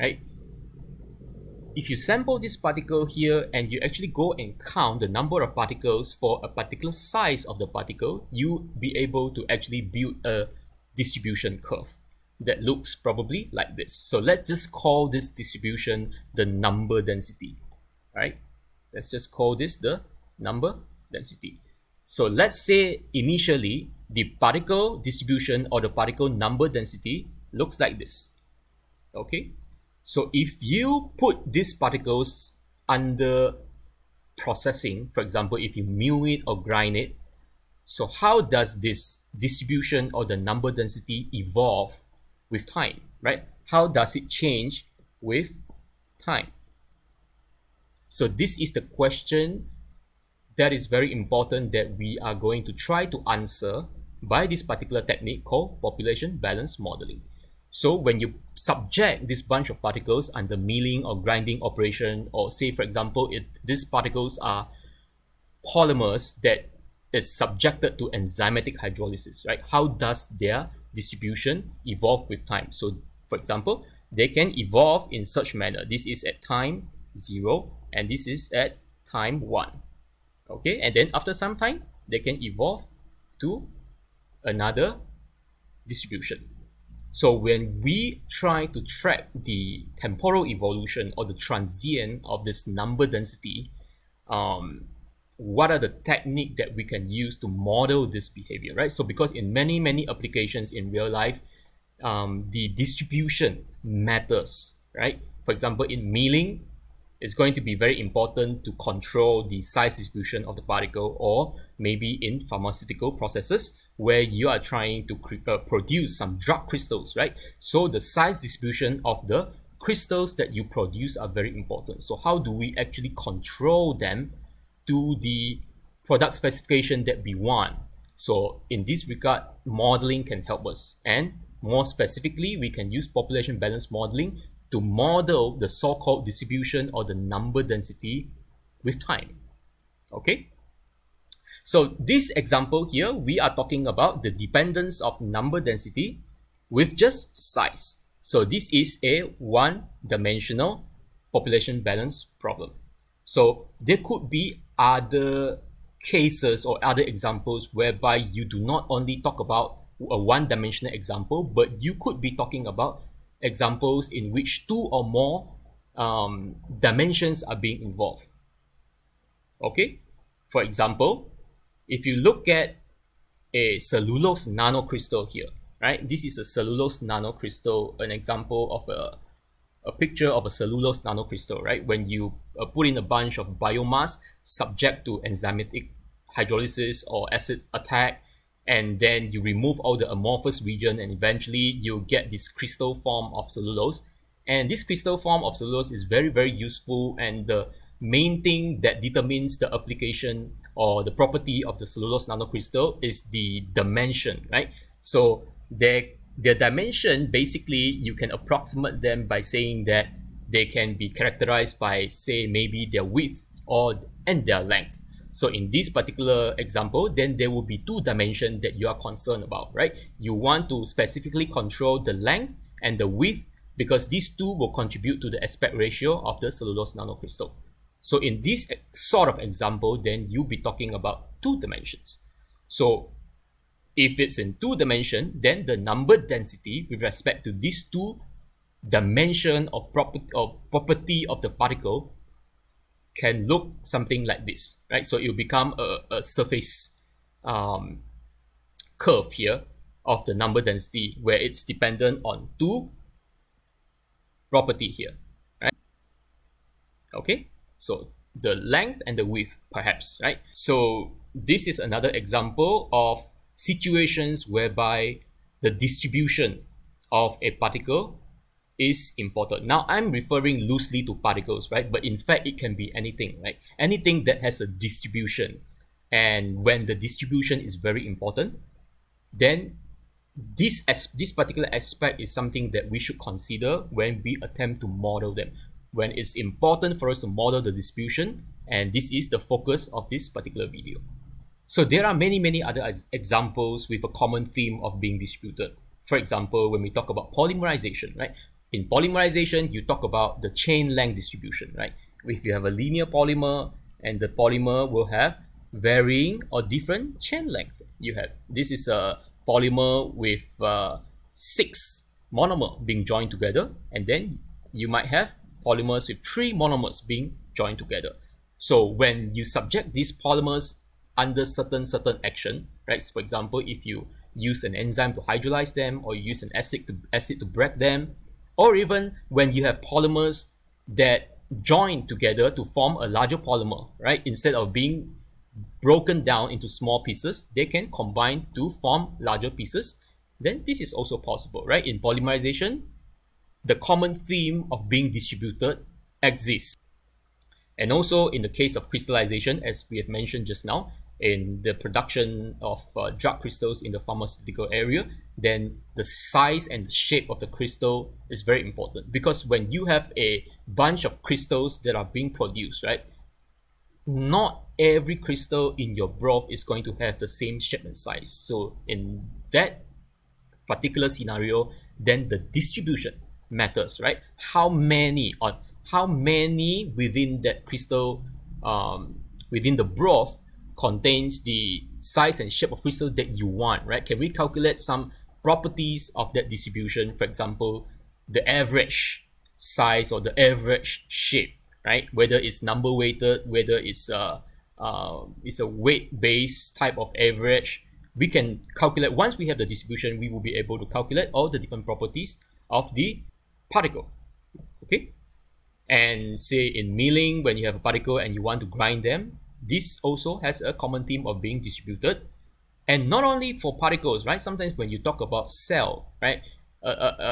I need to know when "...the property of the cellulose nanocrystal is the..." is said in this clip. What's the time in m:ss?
3:21.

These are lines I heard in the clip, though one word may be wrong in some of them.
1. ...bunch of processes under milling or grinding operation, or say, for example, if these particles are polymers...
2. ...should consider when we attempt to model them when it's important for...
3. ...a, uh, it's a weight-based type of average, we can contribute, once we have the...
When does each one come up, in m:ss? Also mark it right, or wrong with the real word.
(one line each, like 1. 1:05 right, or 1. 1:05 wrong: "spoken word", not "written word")
1. 0:59 wrong: "particles", not "processes"
2. 4:42 right
3. 6:34 wrong: "calculate", not "contribute".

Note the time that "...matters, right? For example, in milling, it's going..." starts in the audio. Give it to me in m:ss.
1:43.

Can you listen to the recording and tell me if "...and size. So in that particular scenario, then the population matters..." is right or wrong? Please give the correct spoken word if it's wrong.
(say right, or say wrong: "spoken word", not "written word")
wrong: "distribution", not "population".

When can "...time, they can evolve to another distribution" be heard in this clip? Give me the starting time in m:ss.
1:21.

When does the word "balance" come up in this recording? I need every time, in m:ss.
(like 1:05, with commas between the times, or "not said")
0:56, 2:13, 2:31.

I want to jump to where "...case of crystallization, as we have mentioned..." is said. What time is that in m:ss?
5:48.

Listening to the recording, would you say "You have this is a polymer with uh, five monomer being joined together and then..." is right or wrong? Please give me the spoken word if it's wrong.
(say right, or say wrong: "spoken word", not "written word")
wrong: "six", not "five".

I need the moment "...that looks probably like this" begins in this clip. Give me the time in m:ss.
0:12.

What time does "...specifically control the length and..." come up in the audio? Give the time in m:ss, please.
3:40.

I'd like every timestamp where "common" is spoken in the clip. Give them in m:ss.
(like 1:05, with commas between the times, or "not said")
4:54, 5:43, 6:50.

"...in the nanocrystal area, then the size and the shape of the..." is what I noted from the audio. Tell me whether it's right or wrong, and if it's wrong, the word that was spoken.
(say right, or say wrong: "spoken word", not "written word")
wrong: "pharmaceutical", not "nanocrystal".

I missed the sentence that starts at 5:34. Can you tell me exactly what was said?
Instead of being broken down into small pieces, they can combine to form larger pieces.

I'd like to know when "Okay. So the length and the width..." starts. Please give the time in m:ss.
4:17.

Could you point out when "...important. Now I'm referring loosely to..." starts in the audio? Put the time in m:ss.
4:29.